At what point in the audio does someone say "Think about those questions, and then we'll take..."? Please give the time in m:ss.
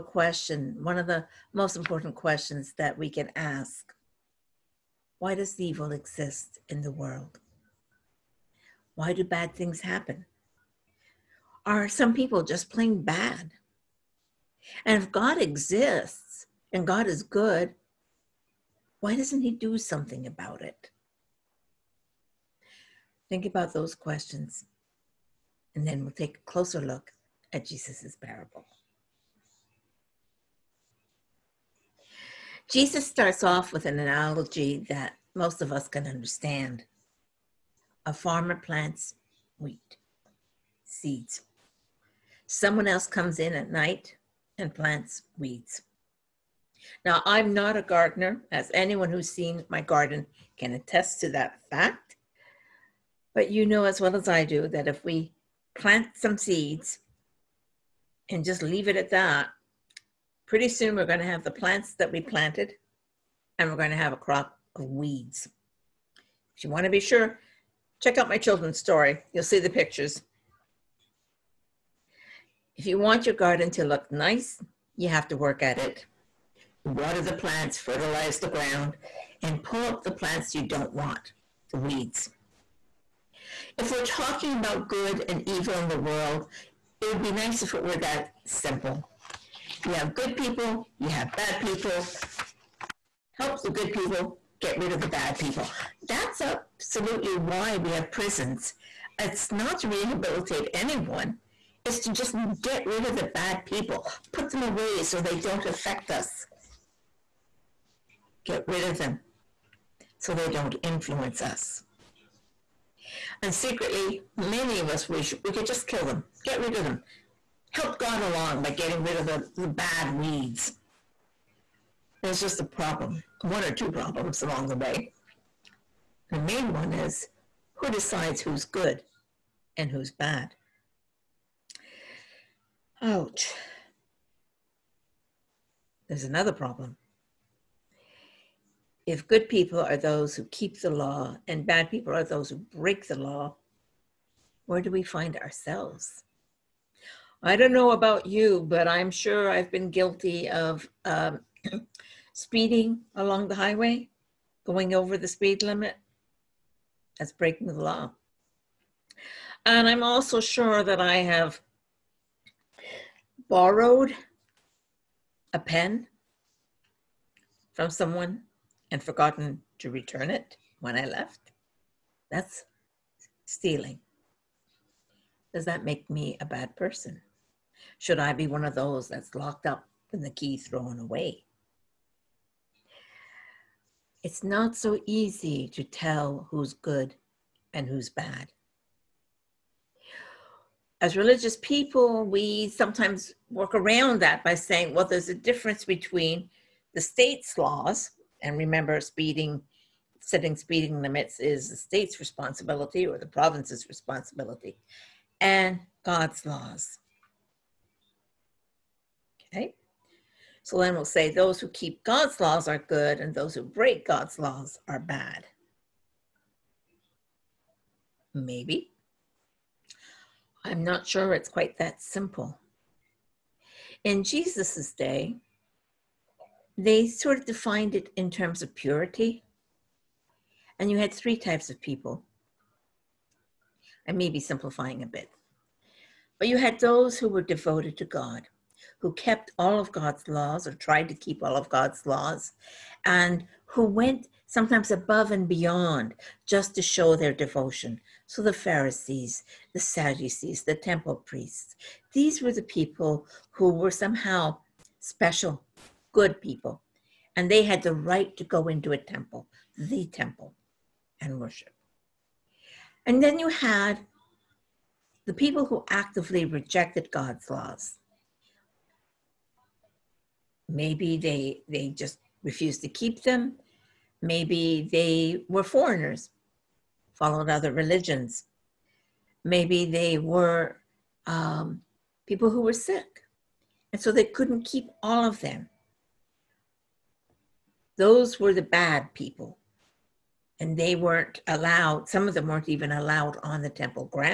0:23.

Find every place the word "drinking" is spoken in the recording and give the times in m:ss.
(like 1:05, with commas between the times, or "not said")
not said.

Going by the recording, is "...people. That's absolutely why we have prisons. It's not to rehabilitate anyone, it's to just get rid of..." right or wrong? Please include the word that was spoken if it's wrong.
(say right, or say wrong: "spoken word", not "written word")
right.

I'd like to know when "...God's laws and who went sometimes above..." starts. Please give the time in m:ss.
4:01.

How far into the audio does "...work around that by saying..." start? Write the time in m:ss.
3:13.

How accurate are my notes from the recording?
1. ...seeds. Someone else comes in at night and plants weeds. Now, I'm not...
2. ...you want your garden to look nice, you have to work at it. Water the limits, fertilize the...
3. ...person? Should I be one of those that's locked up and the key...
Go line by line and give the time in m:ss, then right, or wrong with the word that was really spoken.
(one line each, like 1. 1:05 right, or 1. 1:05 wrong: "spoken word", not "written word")
1. 0:40 right
2. 1:12 wrong: "plants", not "limits"
3. 2:56 right.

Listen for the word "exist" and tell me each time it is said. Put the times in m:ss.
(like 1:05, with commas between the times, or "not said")
0:05, 0:15.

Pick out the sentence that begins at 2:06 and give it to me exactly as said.
The main one is who decides who's good and who's bad?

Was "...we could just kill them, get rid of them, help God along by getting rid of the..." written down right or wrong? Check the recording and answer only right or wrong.
right.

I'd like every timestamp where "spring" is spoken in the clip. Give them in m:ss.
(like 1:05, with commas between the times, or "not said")
not said.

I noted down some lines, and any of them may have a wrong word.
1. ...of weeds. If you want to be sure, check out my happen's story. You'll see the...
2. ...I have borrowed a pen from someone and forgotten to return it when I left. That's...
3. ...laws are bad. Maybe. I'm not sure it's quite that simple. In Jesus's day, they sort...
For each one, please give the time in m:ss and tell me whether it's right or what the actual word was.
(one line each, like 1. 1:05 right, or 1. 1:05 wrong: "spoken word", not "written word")
1. 1:04 wrong: "children", not "happen"
2. 2:41 right
3. 3:34 right.